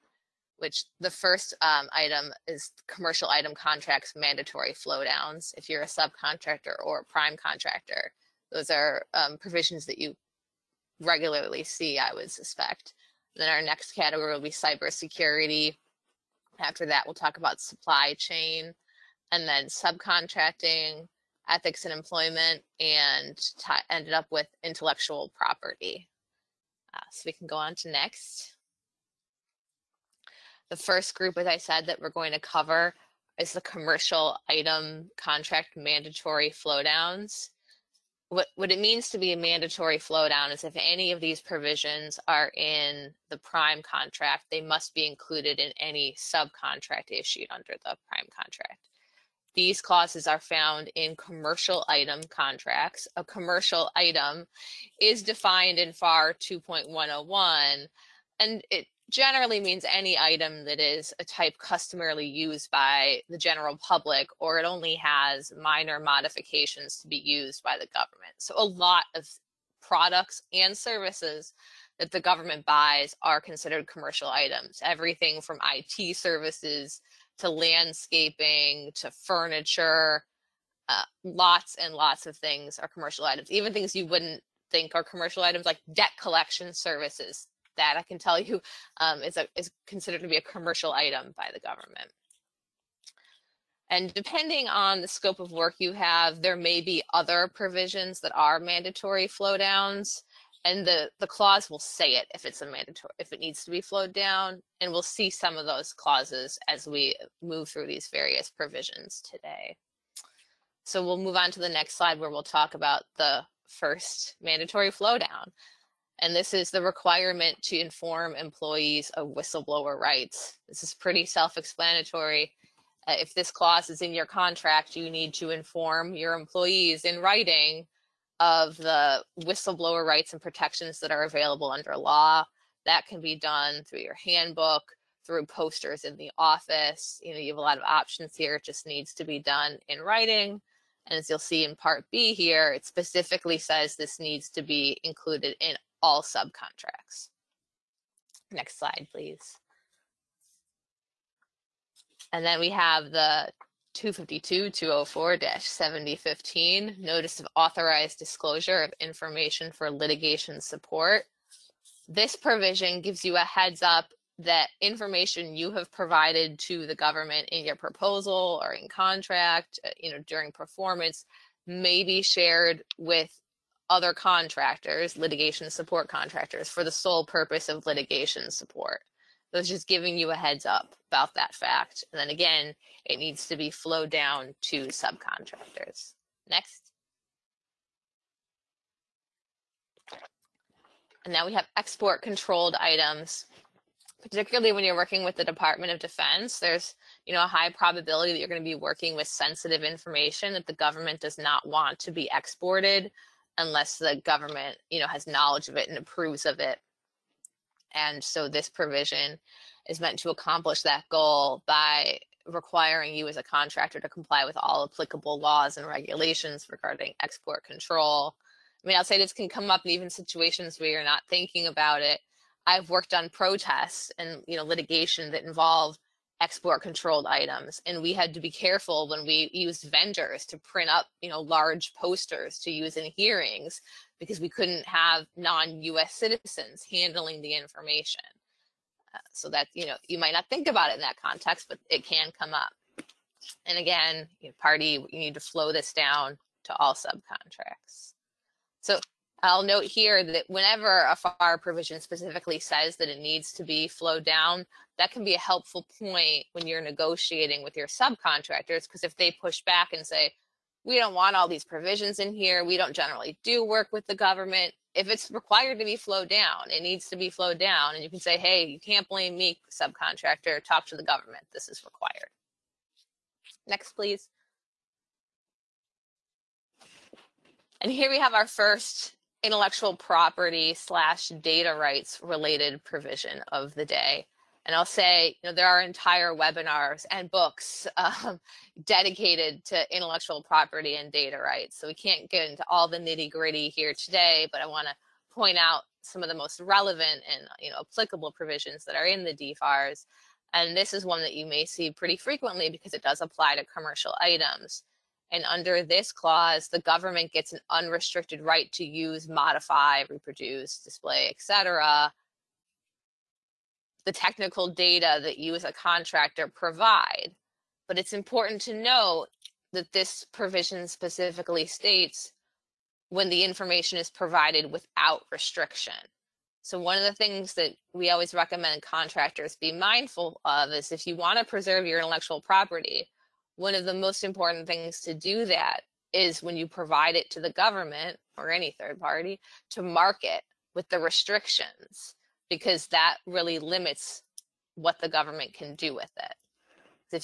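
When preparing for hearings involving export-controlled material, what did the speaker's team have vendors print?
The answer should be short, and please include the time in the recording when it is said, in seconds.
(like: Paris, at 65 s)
Large posters, at 231 s.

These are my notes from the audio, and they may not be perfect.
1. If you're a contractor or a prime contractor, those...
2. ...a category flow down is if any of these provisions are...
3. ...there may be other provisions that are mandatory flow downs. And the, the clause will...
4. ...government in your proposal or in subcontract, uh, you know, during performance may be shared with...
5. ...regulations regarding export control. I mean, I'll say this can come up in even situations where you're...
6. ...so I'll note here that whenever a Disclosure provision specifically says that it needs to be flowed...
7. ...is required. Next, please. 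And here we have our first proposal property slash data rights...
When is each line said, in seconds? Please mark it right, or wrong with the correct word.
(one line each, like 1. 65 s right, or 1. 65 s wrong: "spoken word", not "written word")
1. 5 s wrong: "subcontractor", not "contractor"
2. 39 s wrong: "mandatory", not "category"
3. 96 s right
4. 166 s wrong: "contract", not "subcontract"
5. 215 s right
6. 248 s wrong: "FAR", not "Disclosure"
7. 271 s wrong: "intellectual", not "proposal".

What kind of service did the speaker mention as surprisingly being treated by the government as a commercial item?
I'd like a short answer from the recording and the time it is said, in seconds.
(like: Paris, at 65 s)
Debt collection services, at 85 s.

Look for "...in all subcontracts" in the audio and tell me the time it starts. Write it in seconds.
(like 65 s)
145 s.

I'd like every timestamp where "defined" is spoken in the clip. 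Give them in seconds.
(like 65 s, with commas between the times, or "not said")
55 s.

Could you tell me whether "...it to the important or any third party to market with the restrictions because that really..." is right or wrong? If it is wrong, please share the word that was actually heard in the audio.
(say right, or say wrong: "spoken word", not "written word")
wrong: "government", not "important".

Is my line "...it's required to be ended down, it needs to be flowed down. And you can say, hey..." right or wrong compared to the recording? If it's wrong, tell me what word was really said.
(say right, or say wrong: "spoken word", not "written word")
wrong: "flowed", not "ended".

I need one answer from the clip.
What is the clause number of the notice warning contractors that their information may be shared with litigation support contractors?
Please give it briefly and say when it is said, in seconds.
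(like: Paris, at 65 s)
252-204-7015, at 153 s.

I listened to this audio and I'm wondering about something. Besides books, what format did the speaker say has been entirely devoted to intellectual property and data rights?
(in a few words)
Webinars.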